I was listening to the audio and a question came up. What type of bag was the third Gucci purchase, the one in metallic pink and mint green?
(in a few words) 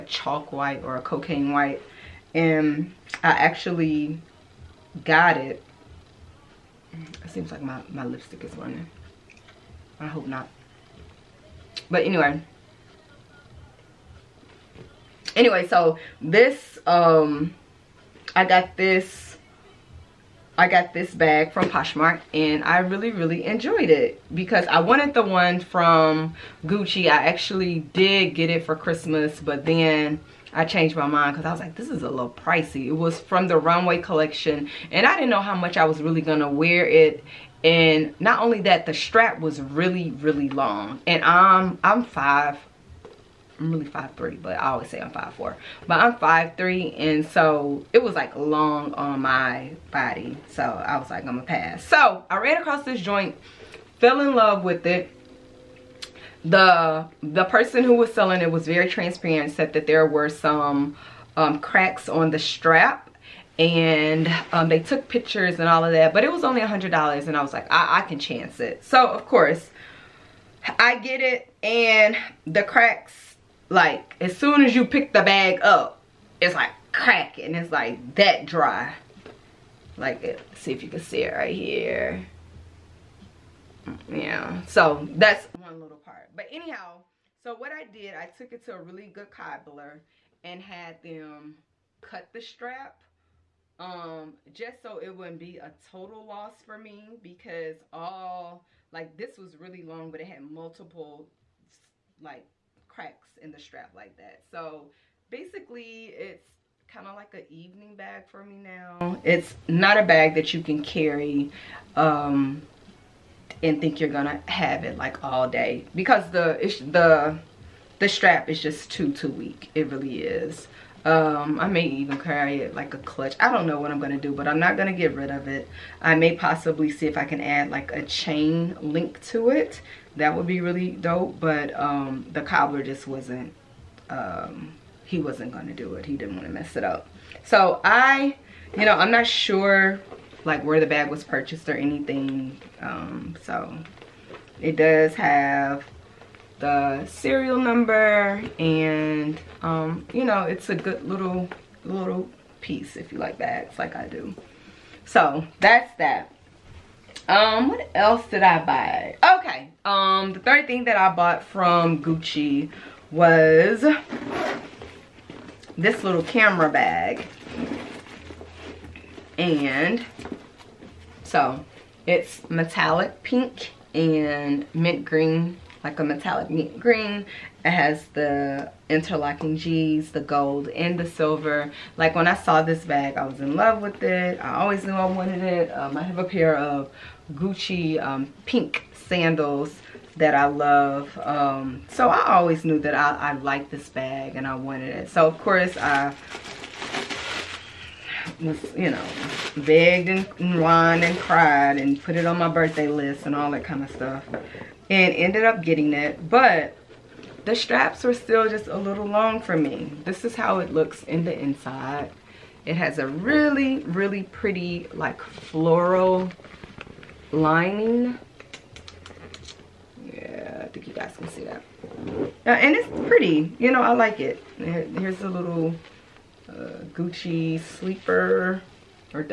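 camera bag.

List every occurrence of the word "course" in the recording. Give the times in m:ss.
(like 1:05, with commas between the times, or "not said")
1:09, 3:15.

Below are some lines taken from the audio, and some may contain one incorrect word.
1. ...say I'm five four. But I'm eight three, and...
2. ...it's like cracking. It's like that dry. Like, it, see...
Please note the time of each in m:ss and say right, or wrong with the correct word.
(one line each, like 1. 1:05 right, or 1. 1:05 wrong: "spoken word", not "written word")
1. 0:44 wrong: "five", not "eight"
2. 1:16 right.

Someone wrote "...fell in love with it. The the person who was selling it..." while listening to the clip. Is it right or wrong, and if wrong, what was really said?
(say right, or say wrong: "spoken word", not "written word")
right.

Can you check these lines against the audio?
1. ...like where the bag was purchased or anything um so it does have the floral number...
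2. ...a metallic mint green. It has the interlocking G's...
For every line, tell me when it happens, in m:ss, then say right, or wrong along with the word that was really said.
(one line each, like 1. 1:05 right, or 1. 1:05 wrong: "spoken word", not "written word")
1. 2:20 wrong: "serial", not "floral"
2. 2:55 right.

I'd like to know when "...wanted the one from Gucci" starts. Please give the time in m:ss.
0:24.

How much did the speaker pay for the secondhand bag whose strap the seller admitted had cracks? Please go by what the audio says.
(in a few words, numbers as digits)
$100.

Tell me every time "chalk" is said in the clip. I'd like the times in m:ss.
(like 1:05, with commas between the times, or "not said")
0:00.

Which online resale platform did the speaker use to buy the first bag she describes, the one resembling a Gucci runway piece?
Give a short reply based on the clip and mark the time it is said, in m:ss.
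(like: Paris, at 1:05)
Poshmark, at 0:21.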